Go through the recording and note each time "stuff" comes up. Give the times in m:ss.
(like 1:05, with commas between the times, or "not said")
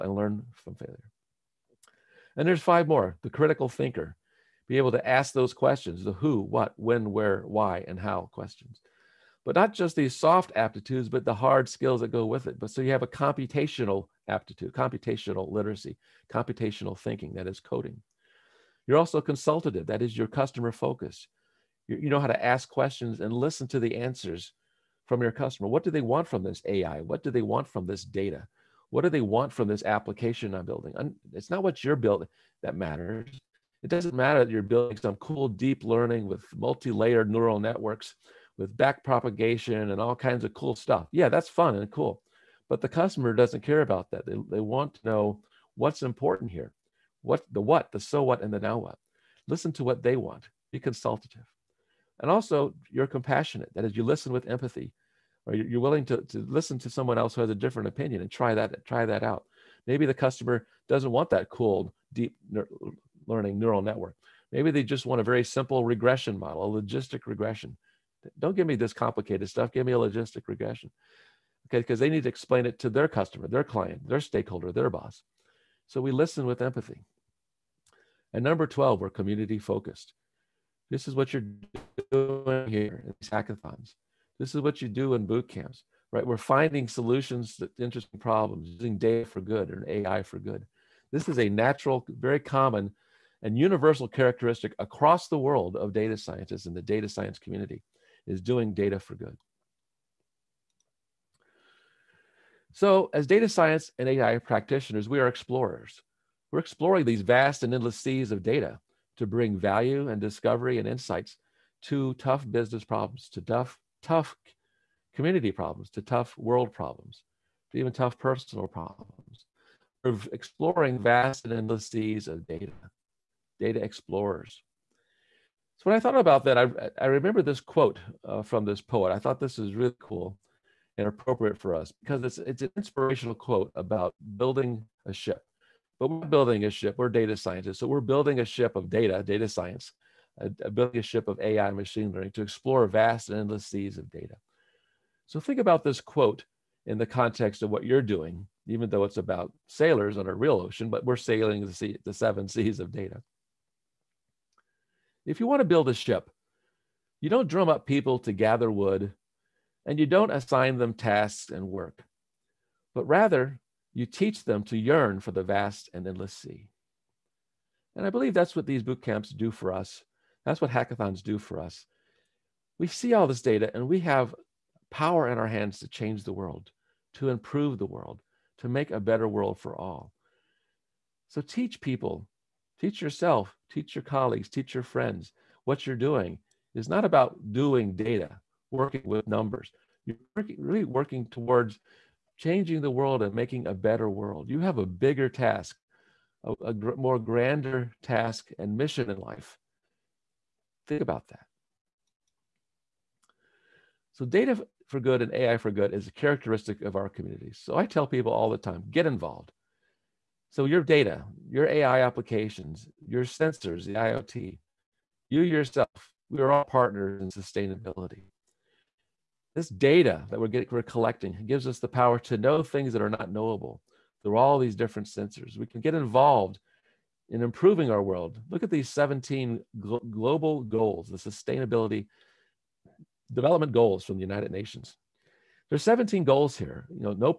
0:40, 1:09.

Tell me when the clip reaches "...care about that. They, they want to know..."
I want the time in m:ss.
0:43.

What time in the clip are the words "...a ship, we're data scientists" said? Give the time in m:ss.
2:16.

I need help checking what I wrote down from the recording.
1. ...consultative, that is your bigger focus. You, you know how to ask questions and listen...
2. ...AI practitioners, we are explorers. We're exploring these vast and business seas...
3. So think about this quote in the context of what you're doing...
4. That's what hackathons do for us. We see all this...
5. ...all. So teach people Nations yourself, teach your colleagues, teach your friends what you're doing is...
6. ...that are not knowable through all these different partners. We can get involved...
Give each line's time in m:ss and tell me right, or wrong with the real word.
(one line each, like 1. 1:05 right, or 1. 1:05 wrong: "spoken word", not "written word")
1. 0:19 wrong: "customer", not "bigger"
2. 1:44 wrong: "endless", not "business"
3. 2:25 right
4. 2:50 right
5. 2:59 wrong: "Teach", not "Nations"
6. 3:42 wrong: "sensors", not "partners".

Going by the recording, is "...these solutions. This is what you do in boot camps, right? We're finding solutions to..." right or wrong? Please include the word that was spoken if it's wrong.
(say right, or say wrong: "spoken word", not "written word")
wrong: "hackathons", not "solutions".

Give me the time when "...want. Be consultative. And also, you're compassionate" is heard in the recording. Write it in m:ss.
0:50.